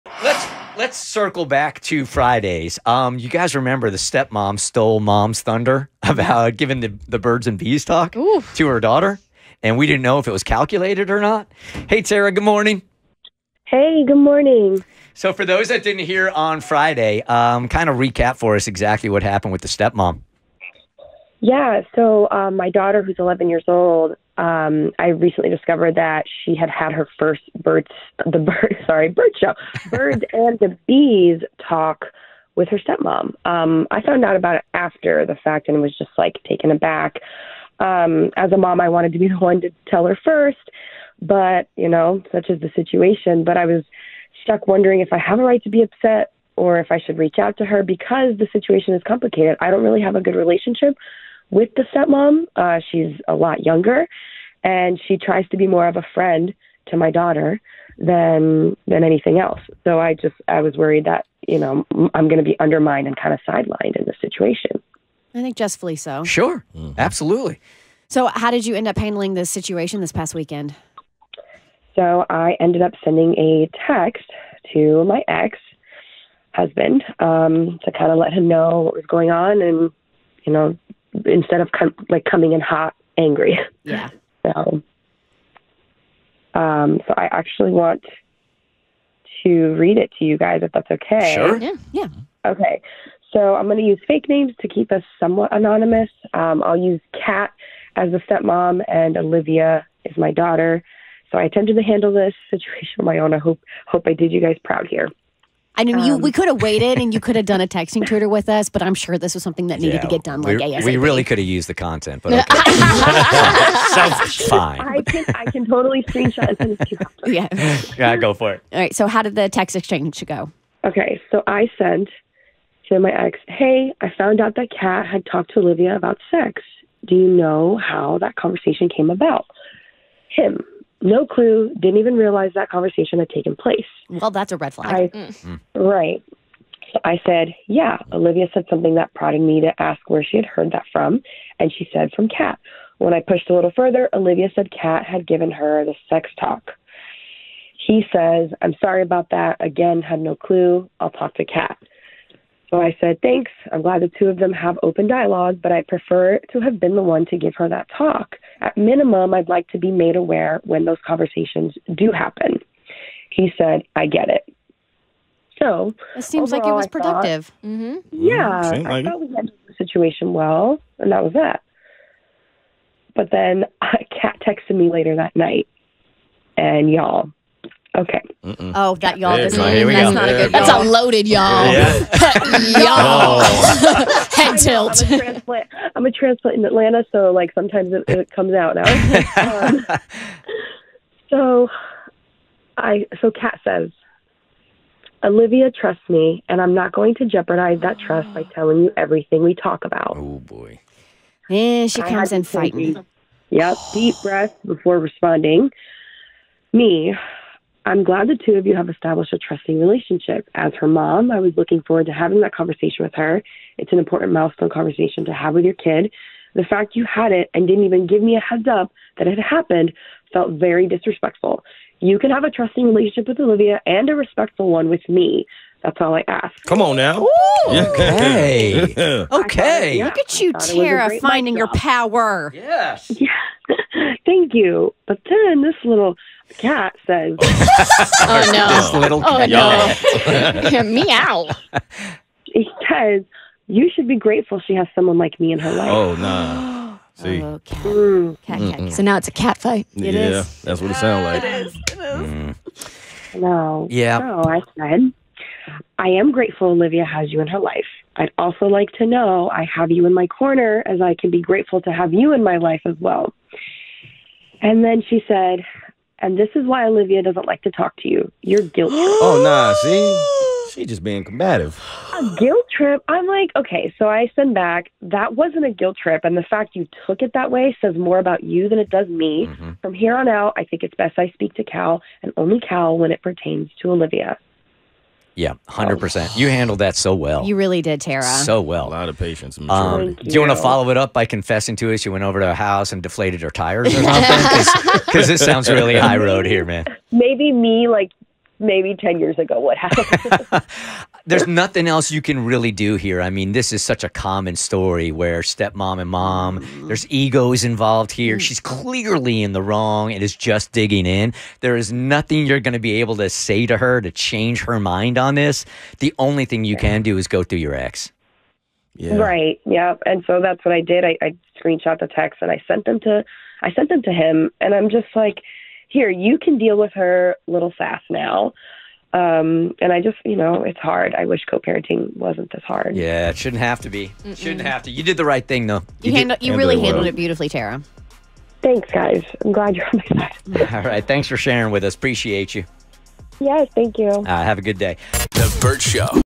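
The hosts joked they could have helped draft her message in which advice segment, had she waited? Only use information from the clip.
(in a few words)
texting tutor.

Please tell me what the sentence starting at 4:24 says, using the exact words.
And then she said, and this is why Olivia doesn't like to talk to you.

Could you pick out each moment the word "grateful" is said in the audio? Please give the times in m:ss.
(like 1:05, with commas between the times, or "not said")
4:04, 4:16, 4:21.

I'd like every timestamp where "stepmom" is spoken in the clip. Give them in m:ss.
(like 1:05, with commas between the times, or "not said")
0:03, 0:19, 0:32, 0:51, 1:38, 5:05.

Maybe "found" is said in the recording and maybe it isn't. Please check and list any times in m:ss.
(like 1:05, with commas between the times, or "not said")
0:34, 2:04.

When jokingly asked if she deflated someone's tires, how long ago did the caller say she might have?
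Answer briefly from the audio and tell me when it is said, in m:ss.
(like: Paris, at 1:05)
10 years ago, at 4:58.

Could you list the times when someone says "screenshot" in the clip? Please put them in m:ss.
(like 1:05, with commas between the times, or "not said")
1:56, 5:21.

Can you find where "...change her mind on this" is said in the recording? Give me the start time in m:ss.
5:14.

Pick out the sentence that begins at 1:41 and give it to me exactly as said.
So I attempted to handle this situation on my own.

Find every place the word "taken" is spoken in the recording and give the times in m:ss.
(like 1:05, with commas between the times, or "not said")
0:36, 2:13.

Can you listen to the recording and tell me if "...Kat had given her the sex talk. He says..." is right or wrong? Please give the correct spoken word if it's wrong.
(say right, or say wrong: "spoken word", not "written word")
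right.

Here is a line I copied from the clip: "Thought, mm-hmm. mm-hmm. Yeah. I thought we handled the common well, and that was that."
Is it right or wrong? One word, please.
wrong.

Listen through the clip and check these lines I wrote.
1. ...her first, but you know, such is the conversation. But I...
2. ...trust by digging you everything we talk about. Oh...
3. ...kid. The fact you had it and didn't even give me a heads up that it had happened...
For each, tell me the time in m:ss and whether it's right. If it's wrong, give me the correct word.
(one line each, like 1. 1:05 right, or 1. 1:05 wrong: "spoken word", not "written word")
1. 0:40 wrong: "situation", not "conversation"
2. 3:17 wrong: "telling", not "digging"
3. 3:35 right.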